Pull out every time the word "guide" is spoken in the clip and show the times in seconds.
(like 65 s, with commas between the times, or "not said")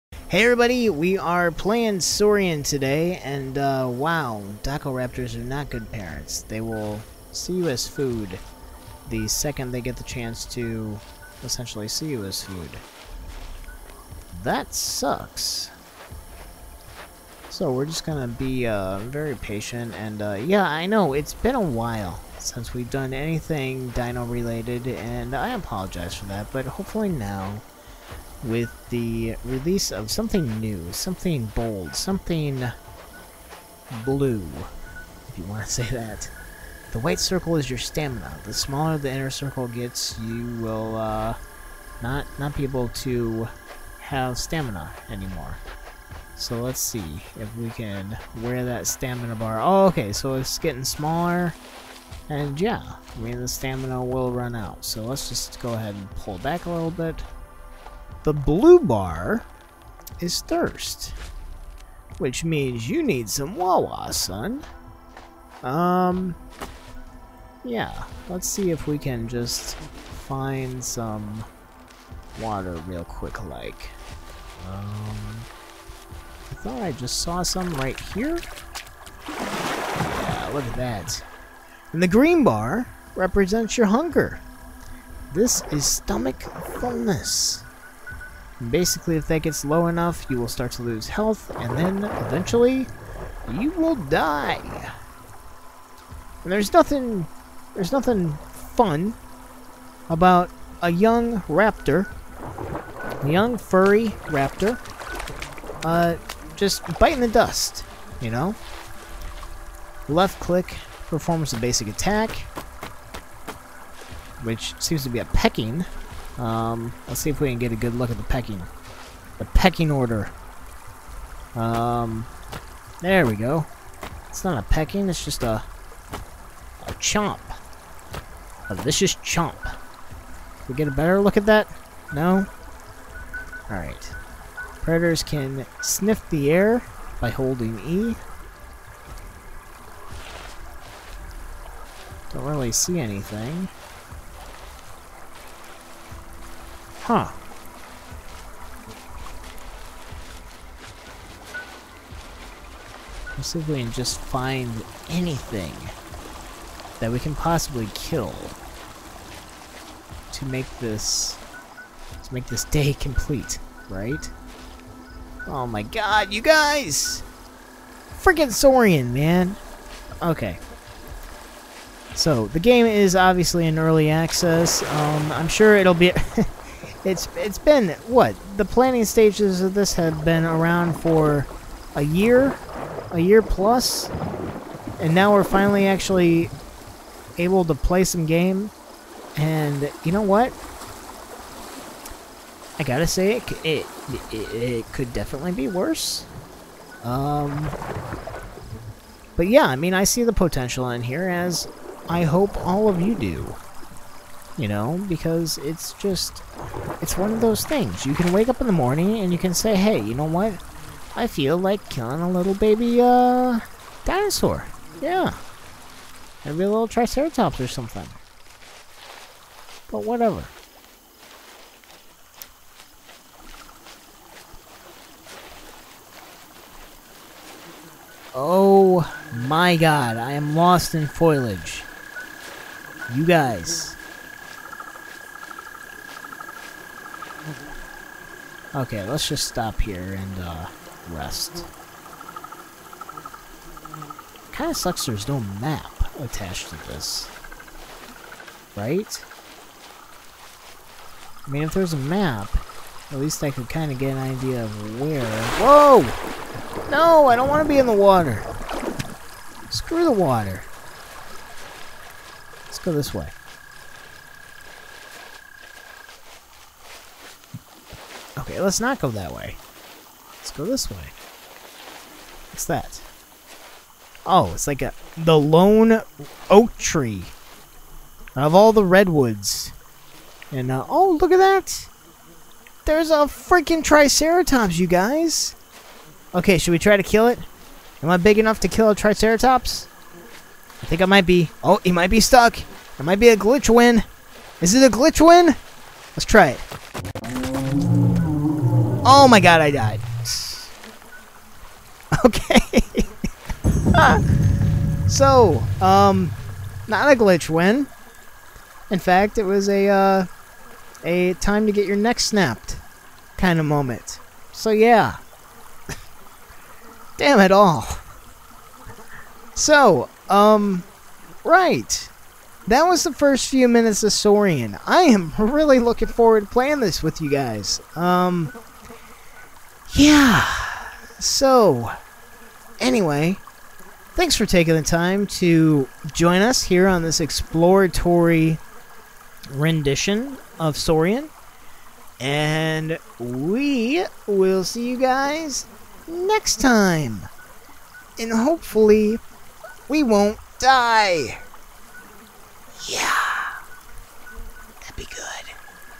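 not said.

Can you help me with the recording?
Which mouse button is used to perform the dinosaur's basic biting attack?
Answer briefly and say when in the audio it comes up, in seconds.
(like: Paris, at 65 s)
Left click, at 110 s.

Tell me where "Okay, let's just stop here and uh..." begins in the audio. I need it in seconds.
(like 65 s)
238 s.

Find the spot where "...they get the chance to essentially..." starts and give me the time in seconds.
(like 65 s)
9 s.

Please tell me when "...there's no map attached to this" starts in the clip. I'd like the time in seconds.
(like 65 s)
245 s.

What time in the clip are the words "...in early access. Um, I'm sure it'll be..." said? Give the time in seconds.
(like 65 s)
173 s.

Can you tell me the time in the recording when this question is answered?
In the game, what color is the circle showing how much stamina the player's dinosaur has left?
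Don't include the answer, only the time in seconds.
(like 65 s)
36 s.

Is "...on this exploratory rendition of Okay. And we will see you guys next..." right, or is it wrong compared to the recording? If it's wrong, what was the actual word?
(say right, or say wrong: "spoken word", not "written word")
wrong: "Saurian", not "Okay".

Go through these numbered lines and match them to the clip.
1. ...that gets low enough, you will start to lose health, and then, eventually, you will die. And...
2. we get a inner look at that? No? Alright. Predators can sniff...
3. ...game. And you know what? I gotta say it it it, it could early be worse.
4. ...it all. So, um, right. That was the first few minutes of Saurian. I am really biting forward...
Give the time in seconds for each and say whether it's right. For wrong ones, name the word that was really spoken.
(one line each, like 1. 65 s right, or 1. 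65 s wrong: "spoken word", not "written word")
1. 89 s right
2. 130 s wrong: "better", not "inner"
3. 188 s wrong: "definitely", not "early"
4. 317 s wrong: "looking", not "biting".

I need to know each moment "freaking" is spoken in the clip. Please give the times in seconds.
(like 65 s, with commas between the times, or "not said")
168 s, 283 s.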